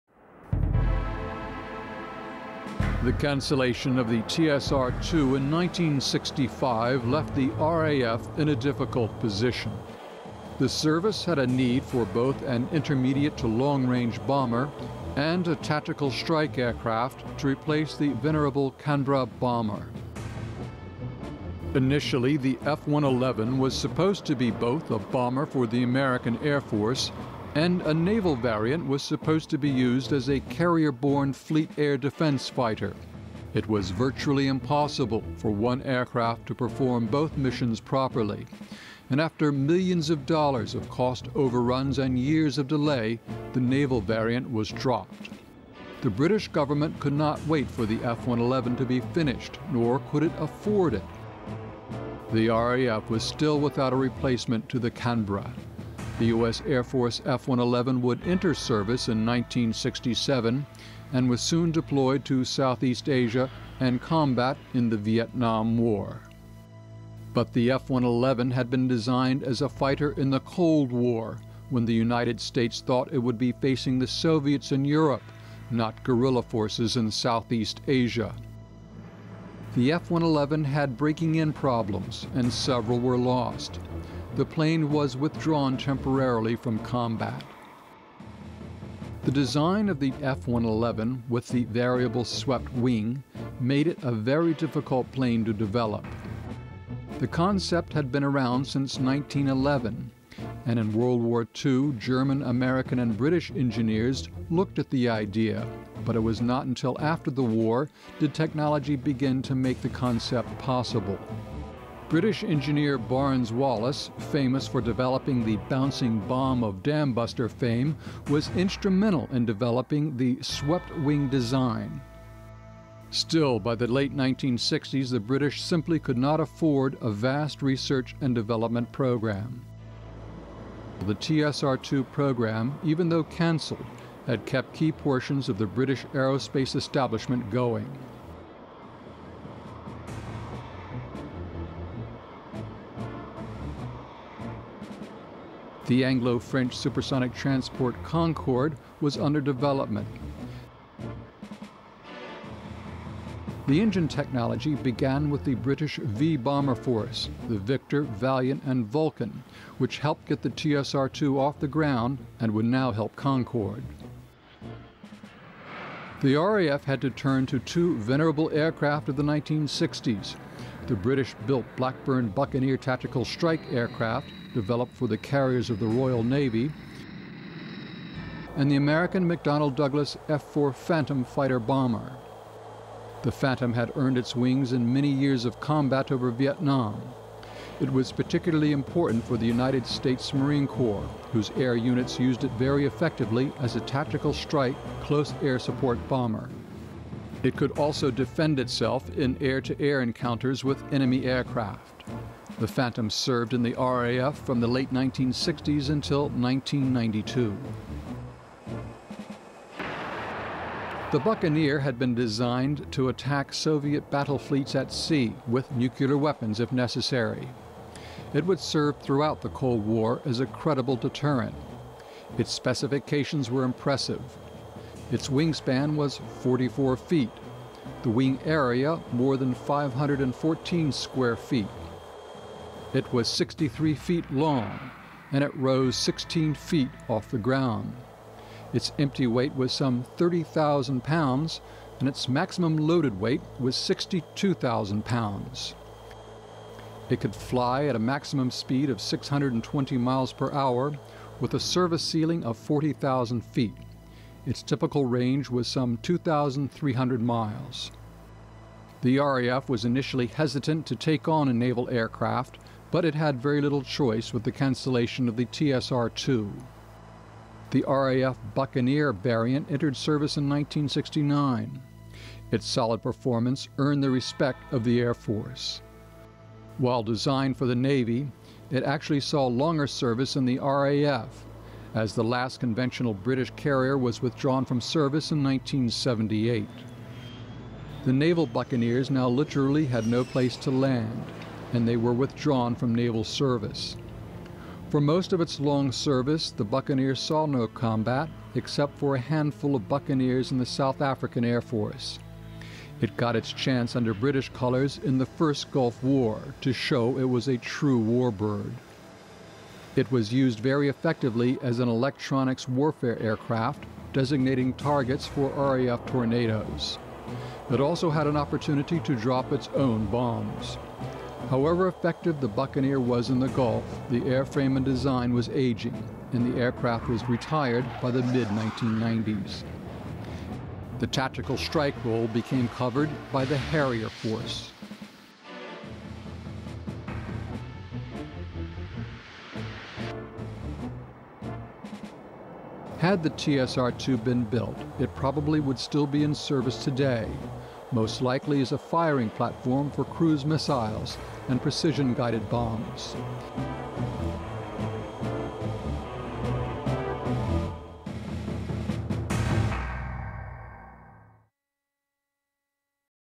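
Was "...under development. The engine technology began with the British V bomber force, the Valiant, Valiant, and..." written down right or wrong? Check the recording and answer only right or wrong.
wrong.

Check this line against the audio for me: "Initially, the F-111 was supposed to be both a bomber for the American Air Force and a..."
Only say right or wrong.
right.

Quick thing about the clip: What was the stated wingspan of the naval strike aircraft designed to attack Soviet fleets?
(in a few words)
44 feet.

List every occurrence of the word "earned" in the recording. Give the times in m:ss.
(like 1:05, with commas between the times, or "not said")
3:03, 4:33.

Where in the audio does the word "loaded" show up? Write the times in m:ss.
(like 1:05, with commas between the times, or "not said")
4:02.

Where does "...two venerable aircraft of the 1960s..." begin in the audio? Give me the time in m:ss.
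2:47.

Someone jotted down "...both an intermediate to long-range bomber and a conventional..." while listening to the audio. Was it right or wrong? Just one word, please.
wrong.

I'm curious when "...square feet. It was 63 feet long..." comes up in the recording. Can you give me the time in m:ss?
3:50.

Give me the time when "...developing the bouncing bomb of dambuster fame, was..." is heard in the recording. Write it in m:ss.
1:54.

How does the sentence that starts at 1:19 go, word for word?
The F-111 had breaking in problems, and several were lost.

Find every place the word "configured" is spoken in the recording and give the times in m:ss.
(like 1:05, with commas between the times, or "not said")
not said.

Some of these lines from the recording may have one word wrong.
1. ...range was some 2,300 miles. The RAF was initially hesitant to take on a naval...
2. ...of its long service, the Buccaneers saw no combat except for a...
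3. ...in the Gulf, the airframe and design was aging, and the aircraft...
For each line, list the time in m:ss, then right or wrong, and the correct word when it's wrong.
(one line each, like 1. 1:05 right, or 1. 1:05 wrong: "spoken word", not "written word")
1. 4:15 right
2. 4:55 right
3. 5:23 right.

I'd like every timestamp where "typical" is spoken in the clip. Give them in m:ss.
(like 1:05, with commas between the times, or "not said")
4:14.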